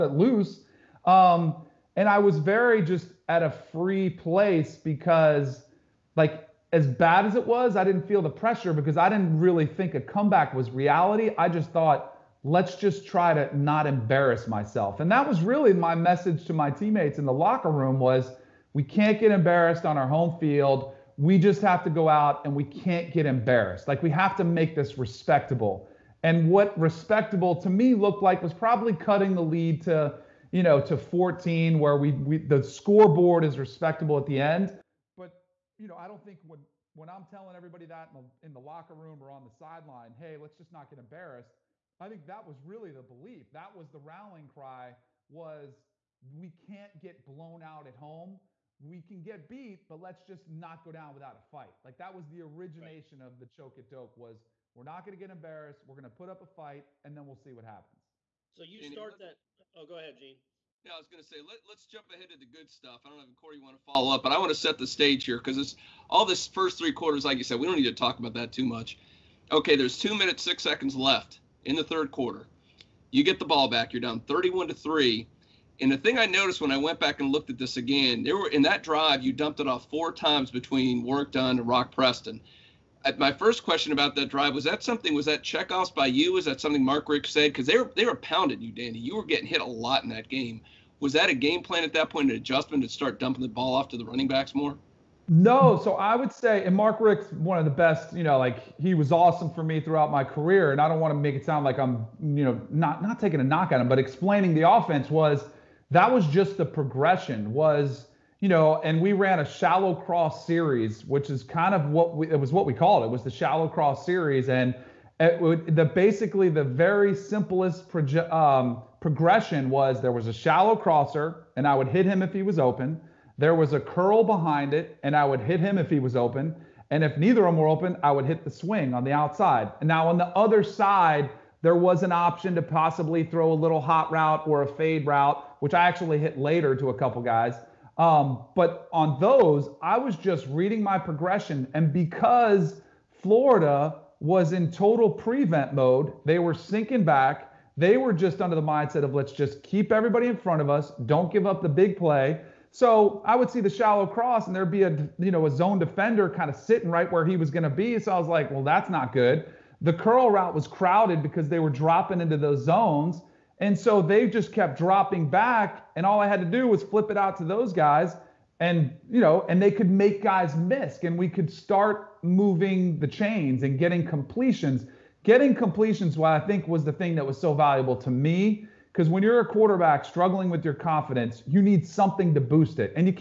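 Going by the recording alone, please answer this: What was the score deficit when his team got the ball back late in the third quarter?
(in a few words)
31 to 3.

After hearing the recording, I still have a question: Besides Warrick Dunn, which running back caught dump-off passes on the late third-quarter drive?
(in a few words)
Rock Preston.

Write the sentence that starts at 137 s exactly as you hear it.
Um, but on those, I was just reading my progression.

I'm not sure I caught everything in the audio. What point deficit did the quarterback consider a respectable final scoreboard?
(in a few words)
14.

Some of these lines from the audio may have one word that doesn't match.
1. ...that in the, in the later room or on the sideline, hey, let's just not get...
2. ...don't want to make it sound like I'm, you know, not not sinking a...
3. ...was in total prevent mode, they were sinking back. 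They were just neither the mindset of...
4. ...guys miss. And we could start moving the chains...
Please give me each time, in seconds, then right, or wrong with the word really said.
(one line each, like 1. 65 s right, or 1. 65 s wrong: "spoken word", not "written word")
1. 37 s wrong: "locker", not "later"
2. 100 s wrong: "taking", not "sinking"
3. 144 s wrong: "under", not "neither"
4. 170 s right.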